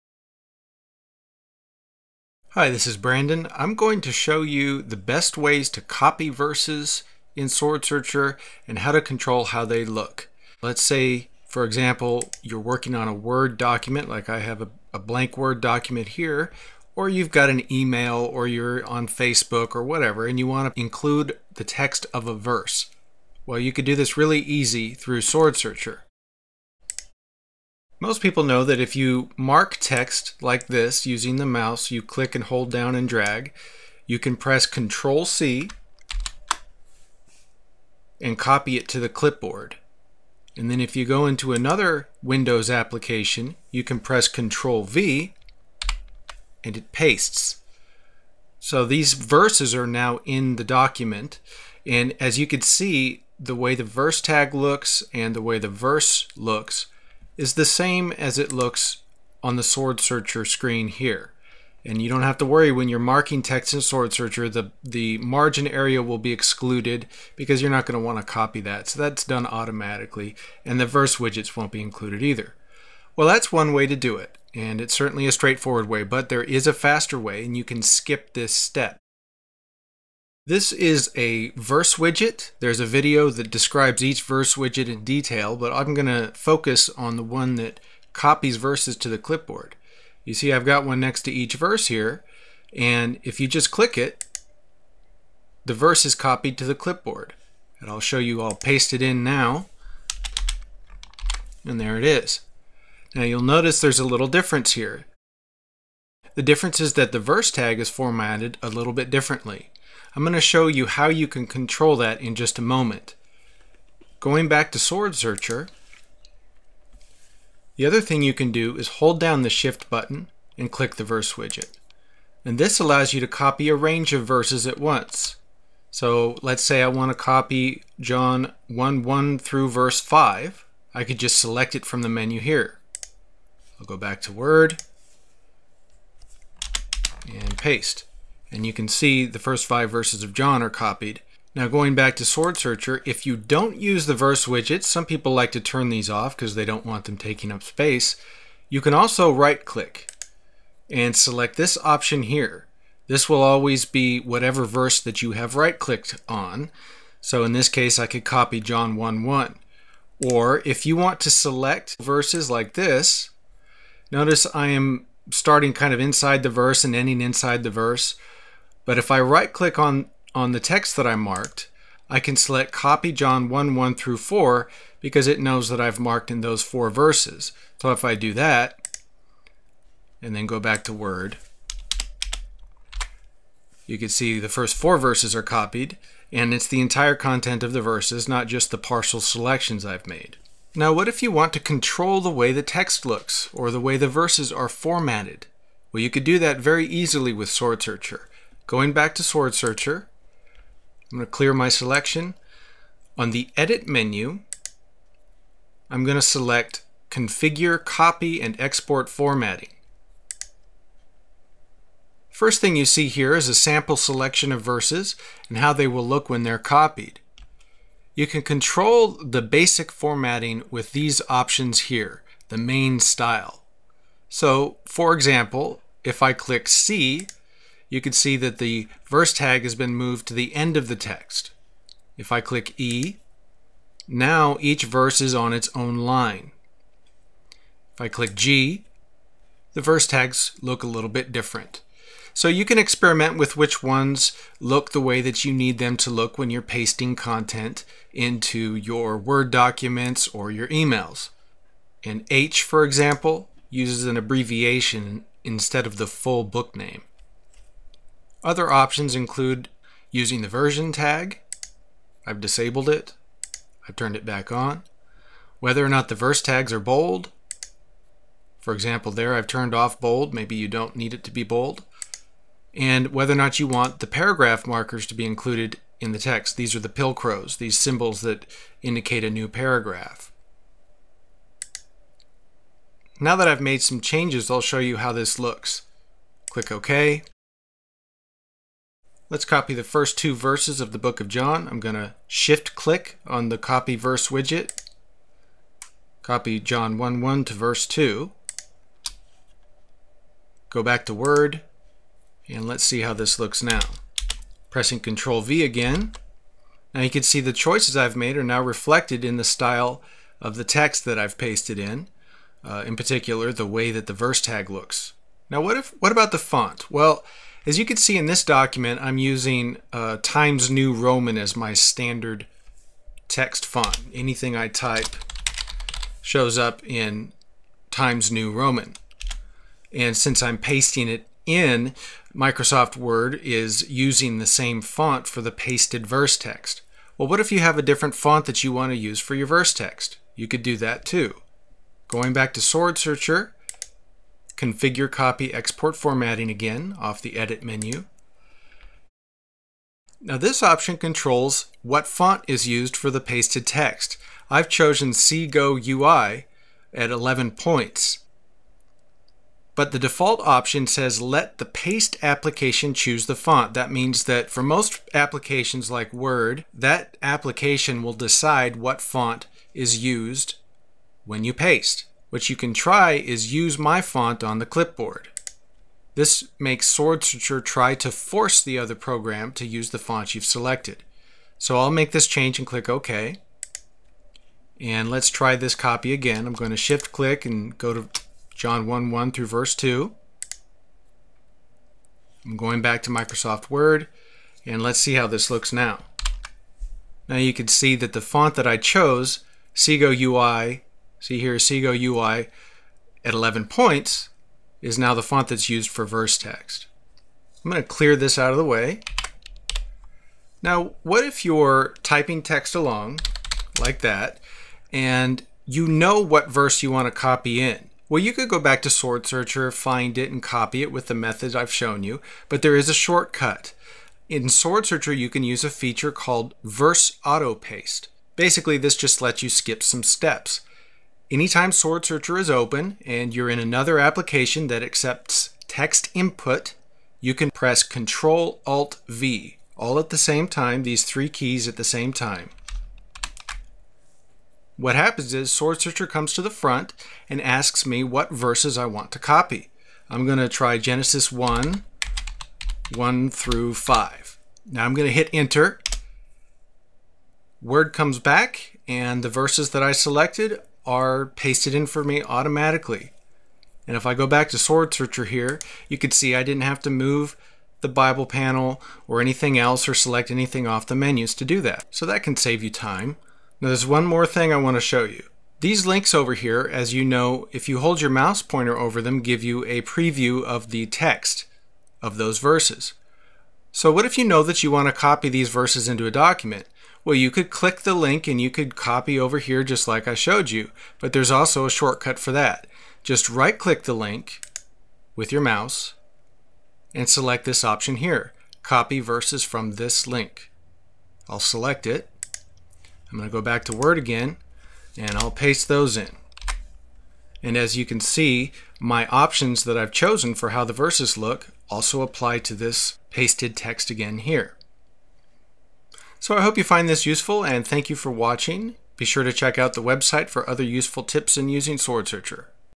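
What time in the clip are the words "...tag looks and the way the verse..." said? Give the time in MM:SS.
00:54.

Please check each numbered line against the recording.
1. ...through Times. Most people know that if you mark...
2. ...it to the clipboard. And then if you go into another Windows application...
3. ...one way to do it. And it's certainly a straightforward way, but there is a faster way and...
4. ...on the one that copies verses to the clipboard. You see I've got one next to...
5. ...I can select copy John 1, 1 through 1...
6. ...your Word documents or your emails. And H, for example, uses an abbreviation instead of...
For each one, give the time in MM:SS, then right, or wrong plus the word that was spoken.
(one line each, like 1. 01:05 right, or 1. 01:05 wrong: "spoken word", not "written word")
1. 00:24 wrong: "SwordSearcher", not "Times"
2. 00:38 right
3. 01:13 right
4. 01:26 right
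5. 02:52 wrong: "4", not "1"
6. 04:08 right.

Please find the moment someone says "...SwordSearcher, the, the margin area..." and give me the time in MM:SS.
01:03.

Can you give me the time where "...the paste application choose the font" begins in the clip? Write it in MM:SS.
06:01.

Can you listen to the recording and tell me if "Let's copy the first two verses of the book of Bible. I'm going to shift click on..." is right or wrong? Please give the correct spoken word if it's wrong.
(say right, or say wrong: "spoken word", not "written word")
wrong: "John", not "Bible".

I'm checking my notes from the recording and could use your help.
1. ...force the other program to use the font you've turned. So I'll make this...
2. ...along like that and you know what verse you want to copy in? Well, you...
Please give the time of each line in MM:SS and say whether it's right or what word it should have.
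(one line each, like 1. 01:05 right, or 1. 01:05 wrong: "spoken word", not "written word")
1. 06:18 wrong: "selected", not "turned"
2. 06:52 right.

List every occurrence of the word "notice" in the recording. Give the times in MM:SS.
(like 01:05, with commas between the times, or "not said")
01:43, 02:44.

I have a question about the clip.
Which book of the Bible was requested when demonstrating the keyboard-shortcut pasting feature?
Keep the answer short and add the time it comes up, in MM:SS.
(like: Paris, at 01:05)
Genesis, at 07:30.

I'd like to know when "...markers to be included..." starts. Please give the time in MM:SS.
04:34.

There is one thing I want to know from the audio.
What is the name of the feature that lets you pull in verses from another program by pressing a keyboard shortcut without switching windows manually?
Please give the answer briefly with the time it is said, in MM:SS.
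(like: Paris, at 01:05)
Verse Auto Paste, at 07:06.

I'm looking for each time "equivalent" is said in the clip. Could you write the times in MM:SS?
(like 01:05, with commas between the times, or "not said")
not said.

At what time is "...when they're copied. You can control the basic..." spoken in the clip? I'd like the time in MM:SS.
03:36.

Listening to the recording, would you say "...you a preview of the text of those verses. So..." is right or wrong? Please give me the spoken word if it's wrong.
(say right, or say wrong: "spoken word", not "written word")
right.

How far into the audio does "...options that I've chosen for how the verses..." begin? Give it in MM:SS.
08:29.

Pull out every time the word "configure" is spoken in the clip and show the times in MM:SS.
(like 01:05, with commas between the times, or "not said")
03:27, 05:44.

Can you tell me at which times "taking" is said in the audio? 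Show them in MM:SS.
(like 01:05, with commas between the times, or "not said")
02:27.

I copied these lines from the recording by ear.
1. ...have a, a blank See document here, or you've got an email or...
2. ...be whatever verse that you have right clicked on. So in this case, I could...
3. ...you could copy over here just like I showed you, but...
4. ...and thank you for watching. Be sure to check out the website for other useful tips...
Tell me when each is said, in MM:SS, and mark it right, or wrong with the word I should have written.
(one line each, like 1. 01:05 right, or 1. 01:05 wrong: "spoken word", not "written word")
1. 00:14 wrong: "Word", not "See"
2. 02:33 right
3. 08:08 right
4. 08:37 right.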